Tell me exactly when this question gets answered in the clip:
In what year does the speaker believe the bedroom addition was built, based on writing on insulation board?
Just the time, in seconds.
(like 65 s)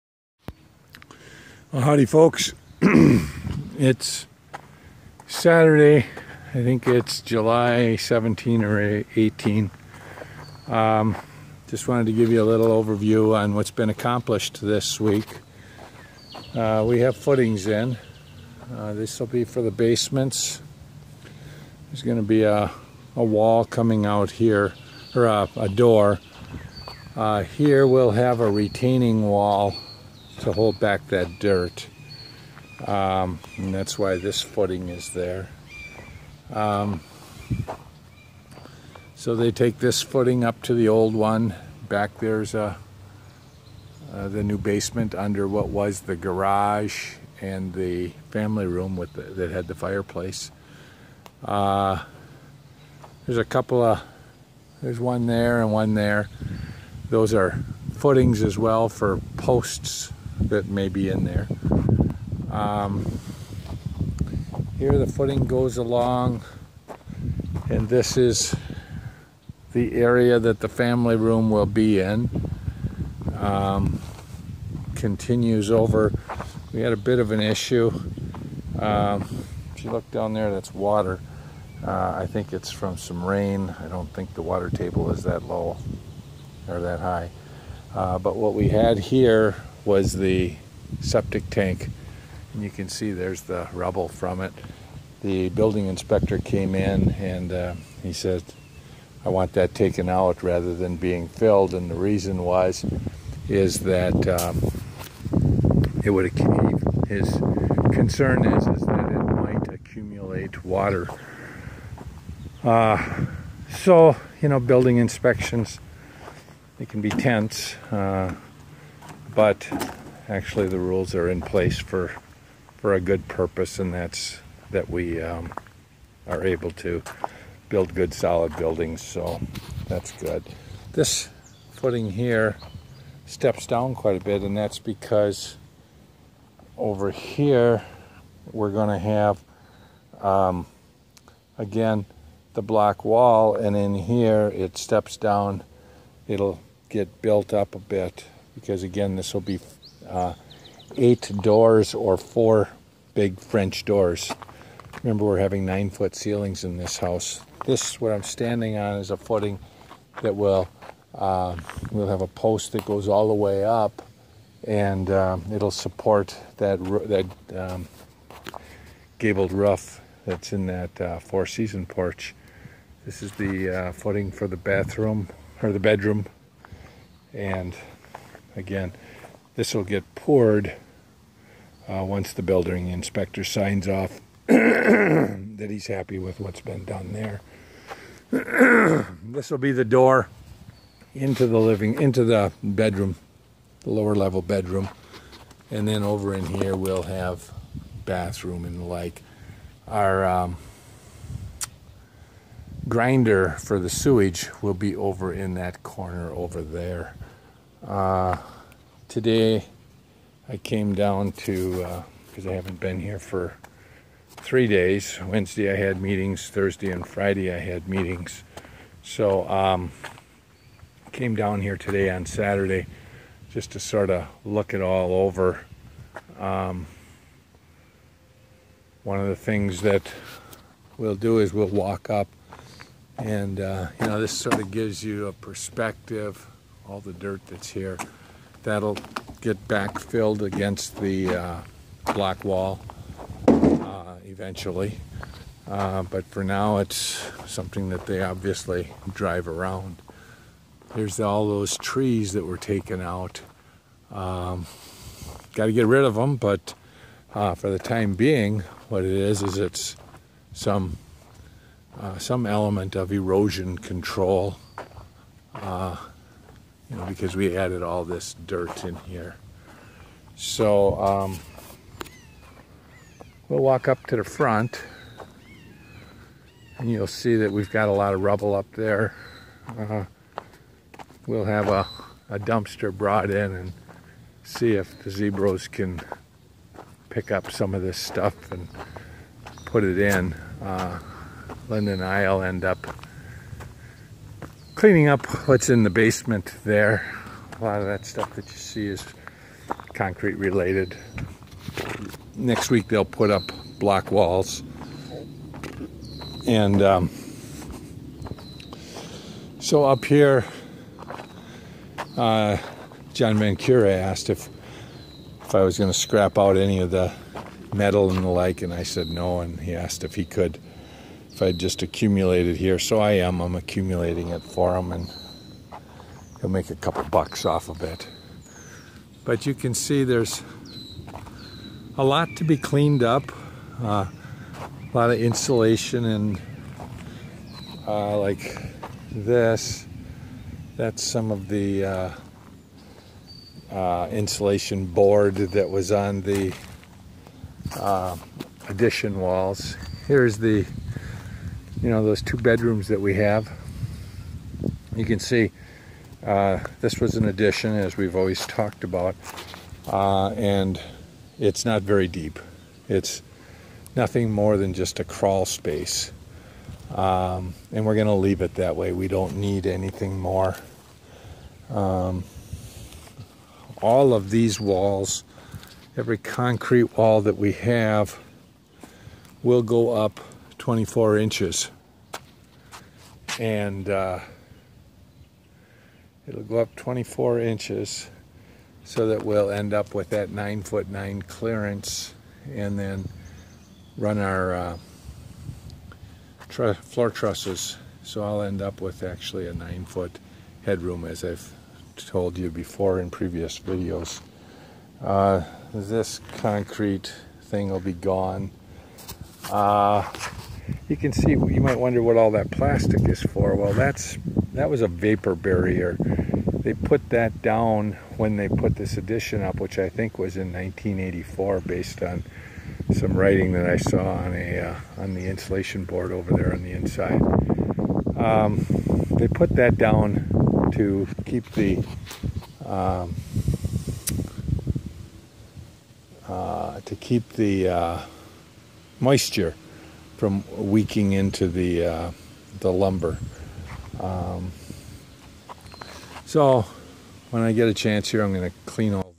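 420 s.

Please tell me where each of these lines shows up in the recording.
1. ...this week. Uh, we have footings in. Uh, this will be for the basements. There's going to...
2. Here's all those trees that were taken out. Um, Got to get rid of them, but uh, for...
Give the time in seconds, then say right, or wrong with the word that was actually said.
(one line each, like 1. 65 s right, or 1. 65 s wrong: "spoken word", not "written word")
1. 14 s right
2. 250 s right.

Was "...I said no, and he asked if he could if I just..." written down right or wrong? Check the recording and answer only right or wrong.
right.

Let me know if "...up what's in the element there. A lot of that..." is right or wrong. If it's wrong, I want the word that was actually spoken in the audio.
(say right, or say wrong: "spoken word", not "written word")
wrong: "basement", not "element".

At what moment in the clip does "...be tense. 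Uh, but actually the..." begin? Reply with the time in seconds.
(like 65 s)
117 s.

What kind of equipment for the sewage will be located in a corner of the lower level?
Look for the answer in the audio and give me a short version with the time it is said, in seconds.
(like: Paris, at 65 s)
grinder, at 202 s.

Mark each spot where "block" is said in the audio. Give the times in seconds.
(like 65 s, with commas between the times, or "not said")
142 s, 242 s, 303 s.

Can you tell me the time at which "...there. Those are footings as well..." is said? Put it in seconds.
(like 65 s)
55 s.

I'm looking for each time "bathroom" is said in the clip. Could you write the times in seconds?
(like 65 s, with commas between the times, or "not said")
174 s, 198 s.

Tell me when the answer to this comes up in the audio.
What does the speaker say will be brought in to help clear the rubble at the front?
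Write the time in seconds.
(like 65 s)
282 s.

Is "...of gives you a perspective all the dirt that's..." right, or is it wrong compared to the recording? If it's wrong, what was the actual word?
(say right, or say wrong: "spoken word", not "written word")
right.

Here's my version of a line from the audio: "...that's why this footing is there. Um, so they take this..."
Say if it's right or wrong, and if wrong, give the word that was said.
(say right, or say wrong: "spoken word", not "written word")
right.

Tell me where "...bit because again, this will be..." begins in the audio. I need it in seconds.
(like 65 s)
147 s.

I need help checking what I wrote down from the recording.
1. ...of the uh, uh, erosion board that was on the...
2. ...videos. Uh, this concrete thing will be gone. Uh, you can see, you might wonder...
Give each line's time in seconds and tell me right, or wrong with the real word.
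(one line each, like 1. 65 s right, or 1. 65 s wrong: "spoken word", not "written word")
1. 341 s wrong: "insulation", not "erosion"
2. 403 s right.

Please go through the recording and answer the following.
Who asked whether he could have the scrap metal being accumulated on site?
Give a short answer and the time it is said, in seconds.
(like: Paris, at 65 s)
John Van Cure, at 313 s.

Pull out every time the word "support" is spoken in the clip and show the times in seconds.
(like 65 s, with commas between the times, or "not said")
165 s.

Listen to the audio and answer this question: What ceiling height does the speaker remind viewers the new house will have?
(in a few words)
9 foot.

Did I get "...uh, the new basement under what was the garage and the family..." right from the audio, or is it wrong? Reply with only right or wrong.
right.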